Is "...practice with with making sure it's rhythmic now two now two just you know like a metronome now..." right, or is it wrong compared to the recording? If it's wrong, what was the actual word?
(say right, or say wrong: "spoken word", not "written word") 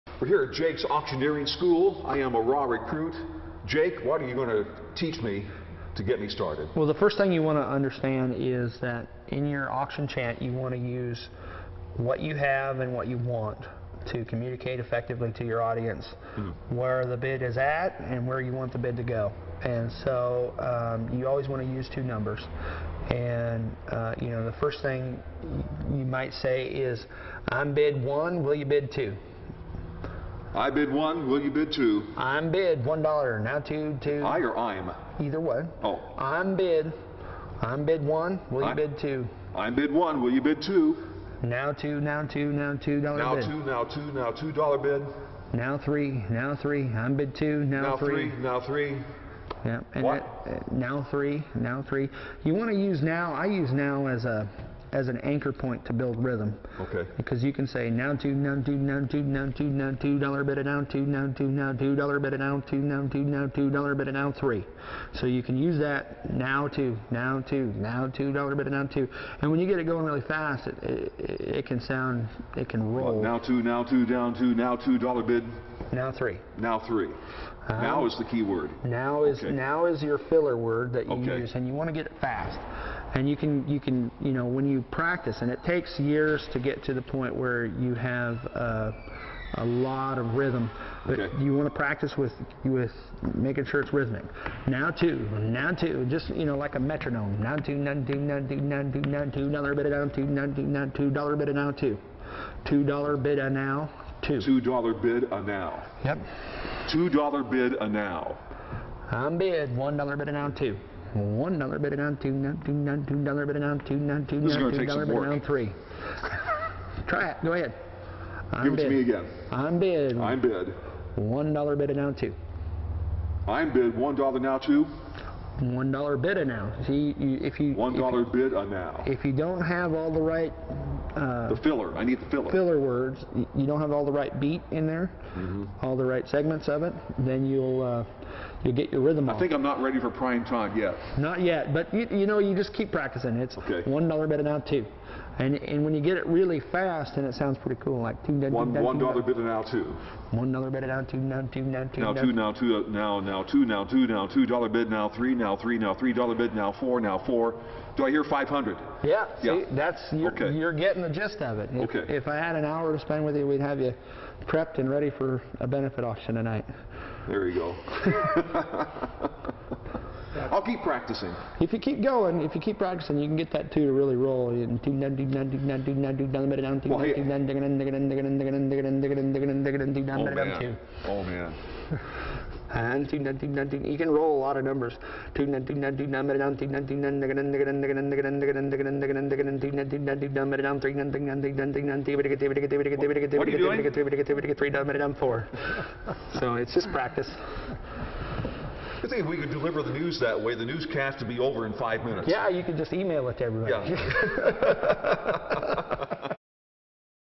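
right.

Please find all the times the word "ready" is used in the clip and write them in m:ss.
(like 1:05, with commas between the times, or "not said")
2:19, 2:44.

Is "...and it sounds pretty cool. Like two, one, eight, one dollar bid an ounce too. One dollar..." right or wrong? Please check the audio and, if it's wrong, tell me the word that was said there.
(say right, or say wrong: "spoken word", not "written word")
wrong: "two", not "eight".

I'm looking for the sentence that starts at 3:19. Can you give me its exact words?
I think if we could deliver the news that way, the newscast would be over in five minutes.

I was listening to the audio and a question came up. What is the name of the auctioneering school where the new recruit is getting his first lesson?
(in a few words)
Jake's Auctioneering School.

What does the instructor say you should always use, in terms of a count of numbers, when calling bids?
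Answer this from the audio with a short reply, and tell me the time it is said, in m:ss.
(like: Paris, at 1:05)
two numbers, at 0:21.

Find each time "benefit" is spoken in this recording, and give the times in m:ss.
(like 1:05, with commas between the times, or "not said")
2:45.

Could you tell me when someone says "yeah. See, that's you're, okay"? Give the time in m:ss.
2:39.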